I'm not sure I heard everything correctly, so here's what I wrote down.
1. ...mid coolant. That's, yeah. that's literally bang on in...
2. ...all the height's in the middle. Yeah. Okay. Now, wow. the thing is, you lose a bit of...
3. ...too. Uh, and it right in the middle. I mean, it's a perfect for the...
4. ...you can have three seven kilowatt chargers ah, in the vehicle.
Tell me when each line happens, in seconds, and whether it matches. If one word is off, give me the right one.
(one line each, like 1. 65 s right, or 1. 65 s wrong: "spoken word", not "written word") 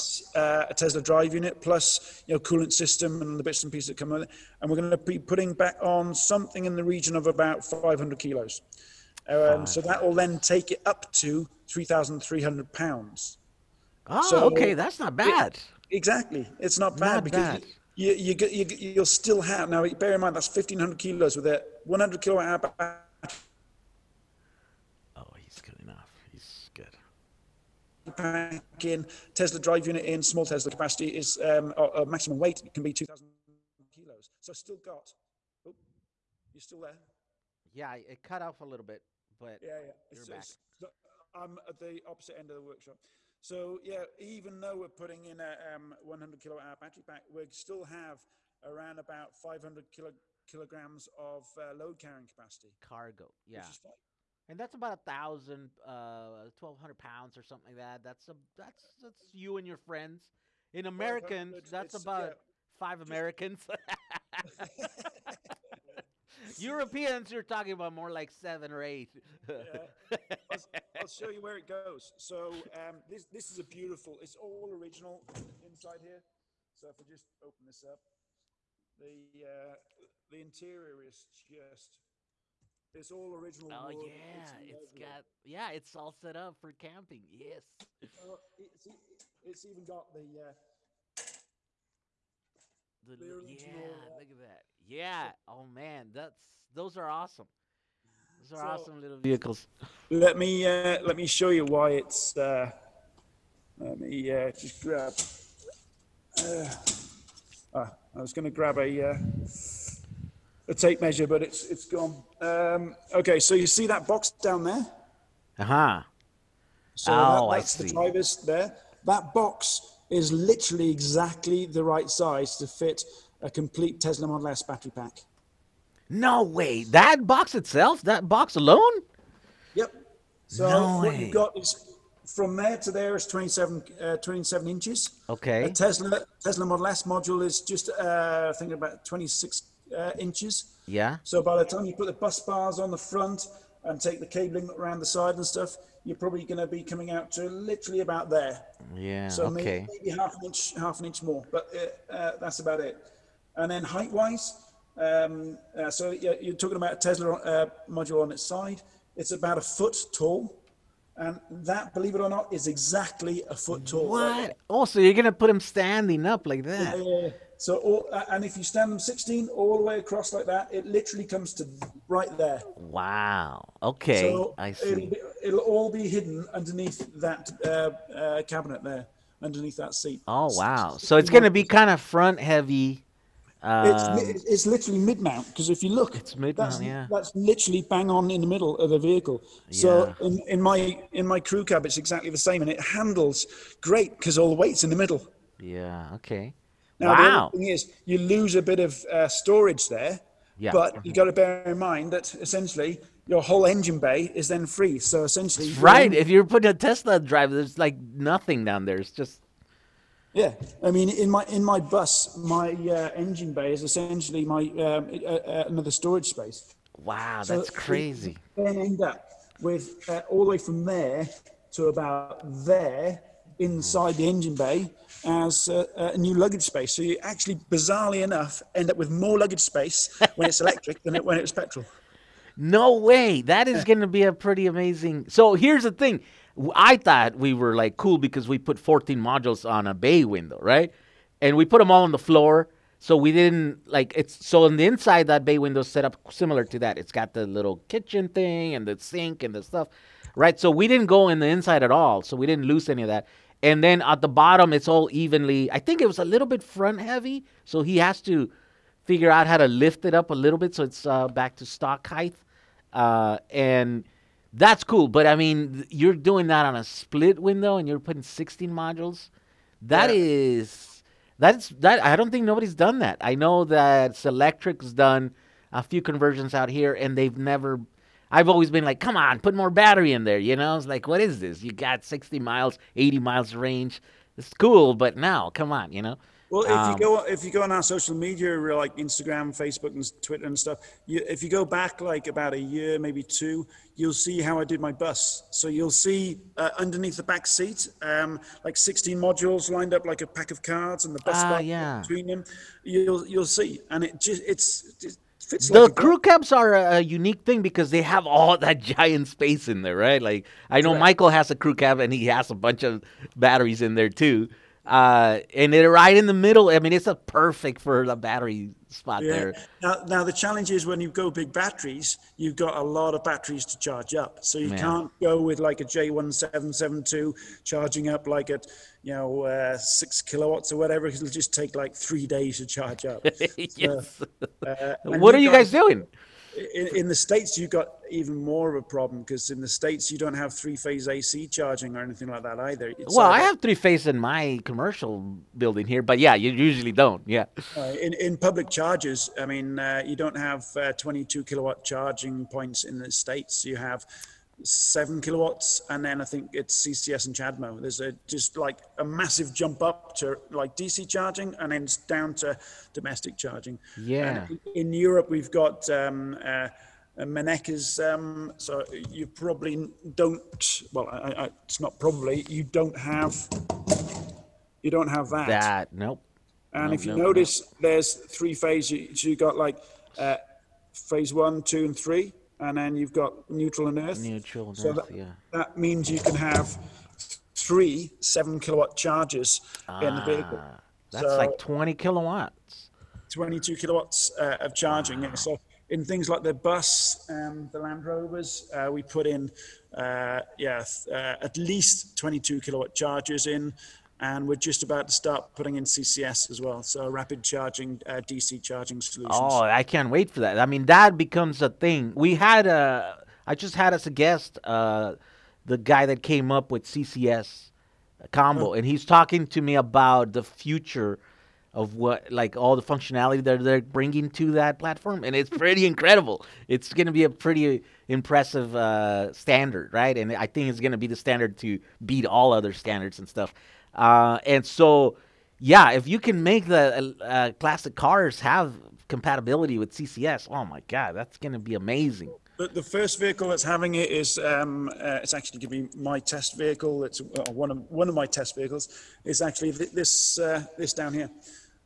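1. 186 s wrong: "mount", not "coolant"
2. 194 s wrong: "weight", not "height"
3. 314 s right
4. 386 s right.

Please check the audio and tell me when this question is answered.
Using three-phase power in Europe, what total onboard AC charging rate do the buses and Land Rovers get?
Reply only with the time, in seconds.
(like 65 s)
393 s.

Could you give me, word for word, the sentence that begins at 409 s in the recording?
Oh, I can't wait for that.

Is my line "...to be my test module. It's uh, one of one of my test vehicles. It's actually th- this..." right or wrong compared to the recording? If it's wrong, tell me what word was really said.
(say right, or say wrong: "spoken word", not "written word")
wrong: "vehicle", not "module".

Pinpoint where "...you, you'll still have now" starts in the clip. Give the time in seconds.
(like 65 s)
18 s.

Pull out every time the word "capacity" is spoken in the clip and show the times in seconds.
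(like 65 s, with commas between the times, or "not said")
30 s, 52 s.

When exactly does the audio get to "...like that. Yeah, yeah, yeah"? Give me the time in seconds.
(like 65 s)
166 s.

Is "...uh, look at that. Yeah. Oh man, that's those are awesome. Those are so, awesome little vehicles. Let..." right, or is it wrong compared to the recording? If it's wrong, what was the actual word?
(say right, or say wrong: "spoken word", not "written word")
right.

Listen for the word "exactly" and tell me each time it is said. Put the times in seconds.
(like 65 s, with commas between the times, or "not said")
15 s, 120 s, 162 s, 191 s.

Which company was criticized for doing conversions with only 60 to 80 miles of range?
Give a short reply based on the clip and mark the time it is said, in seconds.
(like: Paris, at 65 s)
Zelectric, at 274 s.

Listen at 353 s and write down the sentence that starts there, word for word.
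You have seven kilowatts, and then I think it's CCS and CHAdeMO.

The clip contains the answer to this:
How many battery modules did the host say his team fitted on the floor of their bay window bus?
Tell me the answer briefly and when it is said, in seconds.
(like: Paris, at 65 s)
14, at 238 s.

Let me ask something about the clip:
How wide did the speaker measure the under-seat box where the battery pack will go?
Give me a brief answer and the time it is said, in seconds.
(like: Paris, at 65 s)
27 inches, at 134 s.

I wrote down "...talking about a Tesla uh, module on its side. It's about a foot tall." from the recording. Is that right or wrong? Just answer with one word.
right.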